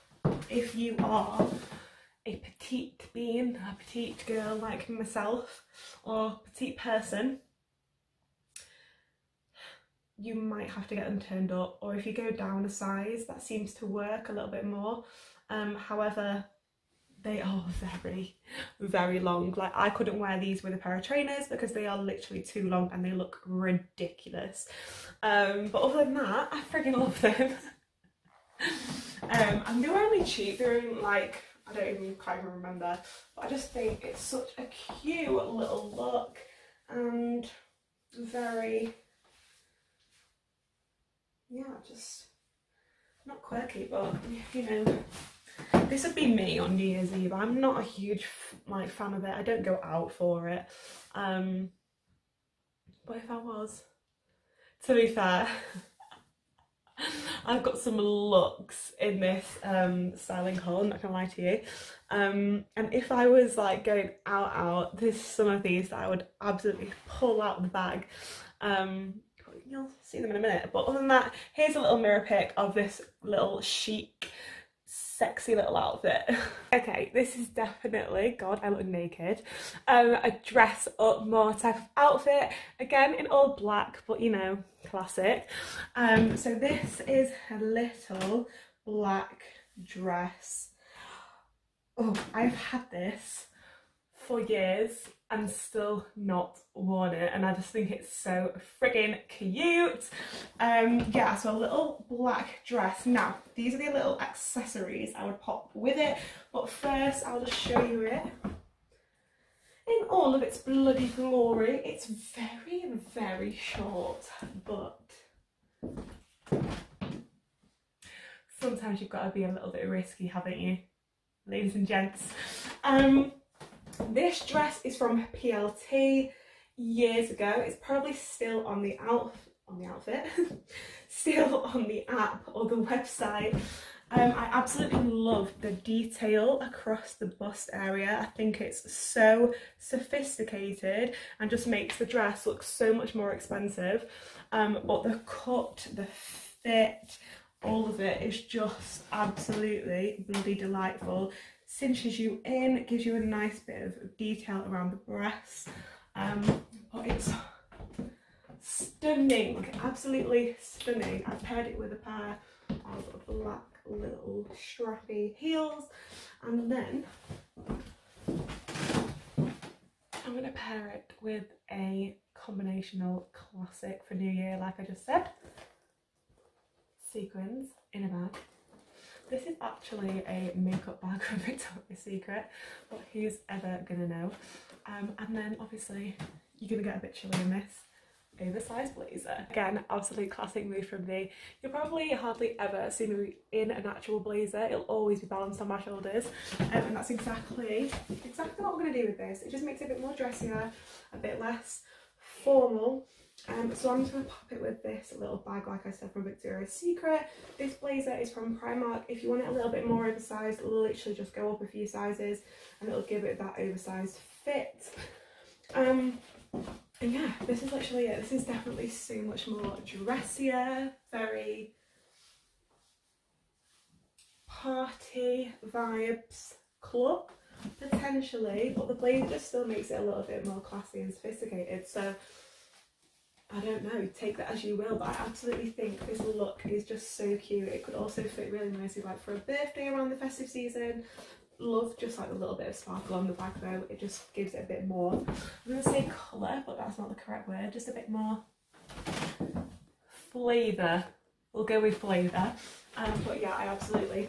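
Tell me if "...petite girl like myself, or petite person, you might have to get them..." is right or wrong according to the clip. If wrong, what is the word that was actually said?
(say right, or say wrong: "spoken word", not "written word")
right.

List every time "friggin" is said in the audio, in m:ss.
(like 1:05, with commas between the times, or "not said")
1:38.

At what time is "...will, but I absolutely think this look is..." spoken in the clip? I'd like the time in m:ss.
3:54.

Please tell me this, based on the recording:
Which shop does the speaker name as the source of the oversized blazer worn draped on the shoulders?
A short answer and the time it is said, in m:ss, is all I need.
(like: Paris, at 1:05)
Primark, at 3:28.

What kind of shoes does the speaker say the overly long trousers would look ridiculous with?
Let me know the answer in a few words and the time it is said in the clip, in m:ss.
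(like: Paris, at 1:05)
Trainers, at 0:21.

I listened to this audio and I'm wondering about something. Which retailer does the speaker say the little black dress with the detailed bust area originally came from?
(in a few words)
PLT.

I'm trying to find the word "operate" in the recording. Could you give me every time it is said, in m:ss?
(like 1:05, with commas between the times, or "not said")
not said.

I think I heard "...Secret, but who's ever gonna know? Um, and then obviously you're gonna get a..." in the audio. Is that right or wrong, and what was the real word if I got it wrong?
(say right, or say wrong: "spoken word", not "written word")
right.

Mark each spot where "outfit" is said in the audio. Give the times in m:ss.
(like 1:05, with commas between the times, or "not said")
1:15, 1:21, 2:09.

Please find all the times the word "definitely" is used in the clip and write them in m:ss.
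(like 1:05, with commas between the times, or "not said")
1:17, 3:38.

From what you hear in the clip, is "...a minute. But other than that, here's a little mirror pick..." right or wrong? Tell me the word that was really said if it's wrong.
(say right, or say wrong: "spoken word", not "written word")
right.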